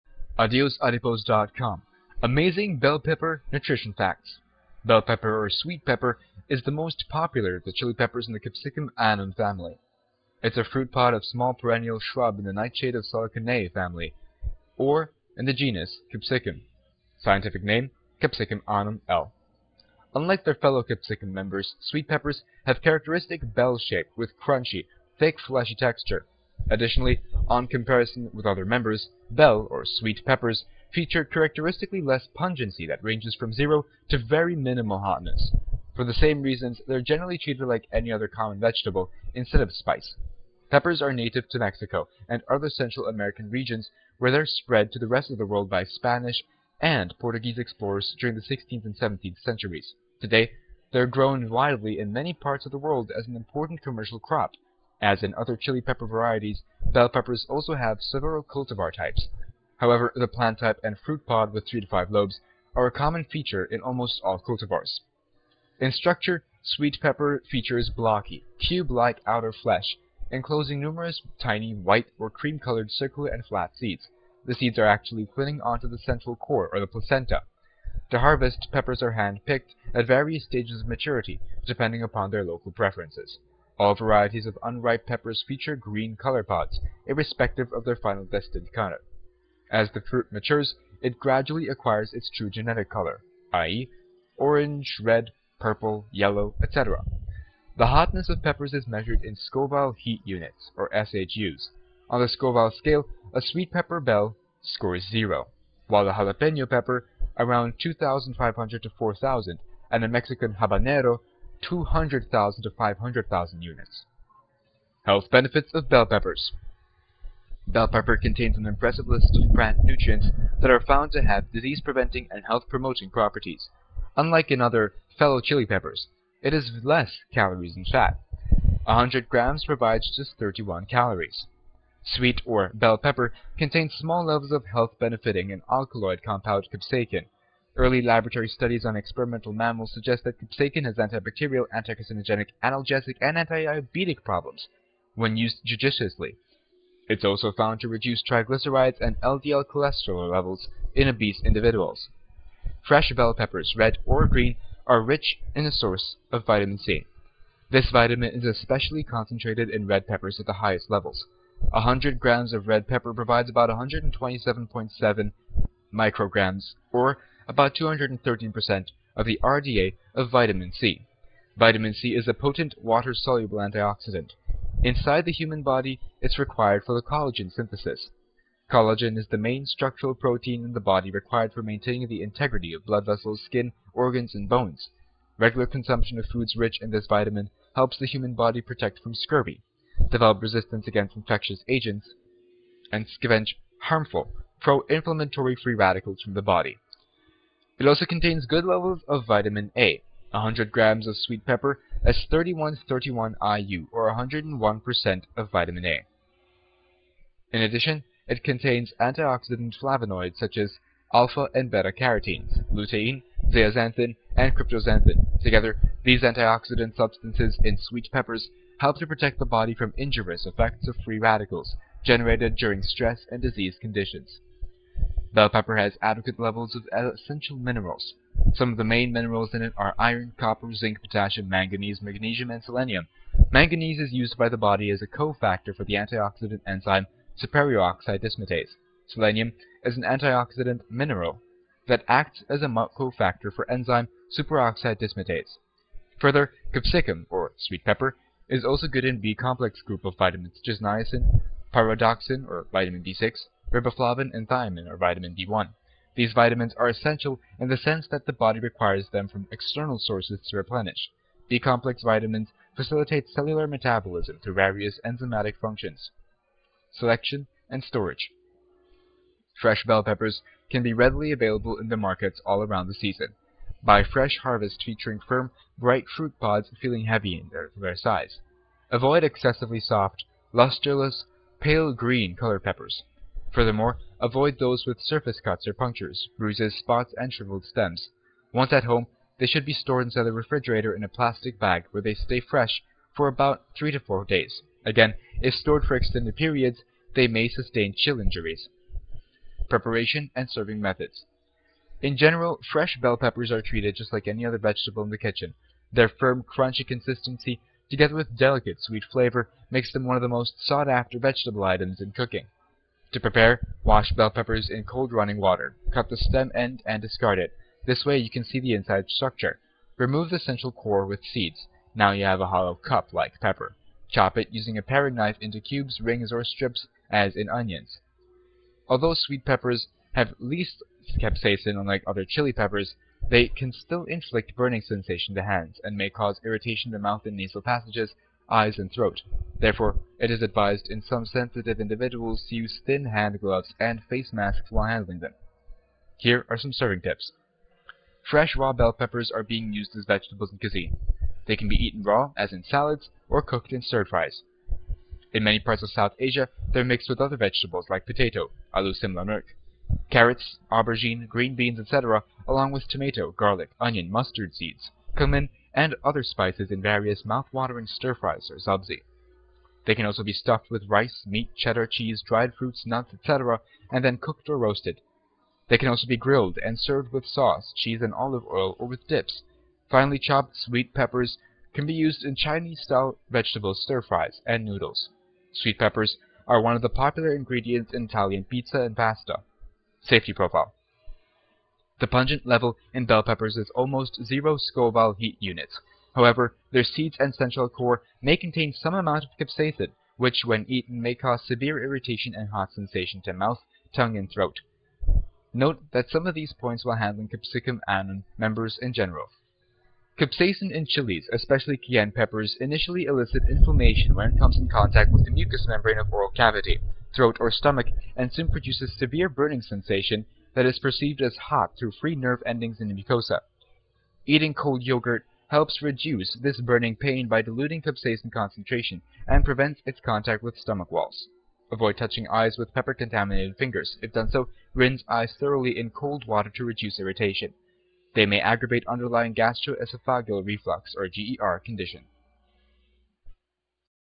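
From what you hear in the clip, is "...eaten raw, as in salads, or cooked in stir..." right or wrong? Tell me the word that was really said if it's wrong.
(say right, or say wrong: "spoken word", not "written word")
right.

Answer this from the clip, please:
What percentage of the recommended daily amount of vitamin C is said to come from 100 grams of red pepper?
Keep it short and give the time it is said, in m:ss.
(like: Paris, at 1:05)
213%, at 2:47.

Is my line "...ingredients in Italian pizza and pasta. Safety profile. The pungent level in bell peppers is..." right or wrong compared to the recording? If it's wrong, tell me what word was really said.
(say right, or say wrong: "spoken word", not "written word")
right.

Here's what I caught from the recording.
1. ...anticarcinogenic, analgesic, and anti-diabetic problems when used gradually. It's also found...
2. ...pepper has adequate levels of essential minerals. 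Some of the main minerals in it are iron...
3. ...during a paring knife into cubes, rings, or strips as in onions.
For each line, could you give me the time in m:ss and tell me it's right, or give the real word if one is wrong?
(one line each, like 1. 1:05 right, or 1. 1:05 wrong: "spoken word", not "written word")
1. 2:21 wrong: "judiciously", not "gradually"
2. 3:45 right
3. 5:24 wrong: "using", not "during".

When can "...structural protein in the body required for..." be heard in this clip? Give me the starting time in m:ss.
2:59.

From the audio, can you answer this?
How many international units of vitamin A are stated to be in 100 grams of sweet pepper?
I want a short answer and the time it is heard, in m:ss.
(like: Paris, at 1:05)
3131 IU, at 3:22.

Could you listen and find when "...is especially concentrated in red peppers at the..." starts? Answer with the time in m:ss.
2:38.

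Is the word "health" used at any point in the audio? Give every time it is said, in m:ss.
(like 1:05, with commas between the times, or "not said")
1:55, 2:02, 2:14.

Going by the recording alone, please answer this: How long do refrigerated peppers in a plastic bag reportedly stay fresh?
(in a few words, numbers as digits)
3 to 4 days.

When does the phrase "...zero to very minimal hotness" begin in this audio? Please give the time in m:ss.
0:33.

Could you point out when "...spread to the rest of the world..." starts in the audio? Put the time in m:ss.
0:44.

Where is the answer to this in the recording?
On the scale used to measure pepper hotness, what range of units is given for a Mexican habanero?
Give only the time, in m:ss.
1:51.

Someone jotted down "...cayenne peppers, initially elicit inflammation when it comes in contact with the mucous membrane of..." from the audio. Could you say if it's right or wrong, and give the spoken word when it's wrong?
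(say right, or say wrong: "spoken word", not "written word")
right.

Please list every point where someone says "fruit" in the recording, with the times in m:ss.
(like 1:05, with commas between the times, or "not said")
0:10, 1:00, 1:30, 4:36, 6:12.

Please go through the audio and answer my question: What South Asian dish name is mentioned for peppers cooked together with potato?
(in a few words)
aloo simla mirch.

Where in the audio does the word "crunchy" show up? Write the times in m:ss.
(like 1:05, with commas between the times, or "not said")
0:24, 5:06.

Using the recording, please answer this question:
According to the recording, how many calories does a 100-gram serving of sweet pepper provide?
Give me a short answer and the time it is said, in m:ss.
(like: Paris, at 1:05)
31, at 2:10.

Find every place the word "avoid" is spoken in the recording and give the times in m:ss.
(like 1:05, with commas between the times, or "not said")
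4:38, 4:44, 7:11.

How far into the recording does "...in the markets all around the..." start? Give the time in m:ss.
4:31.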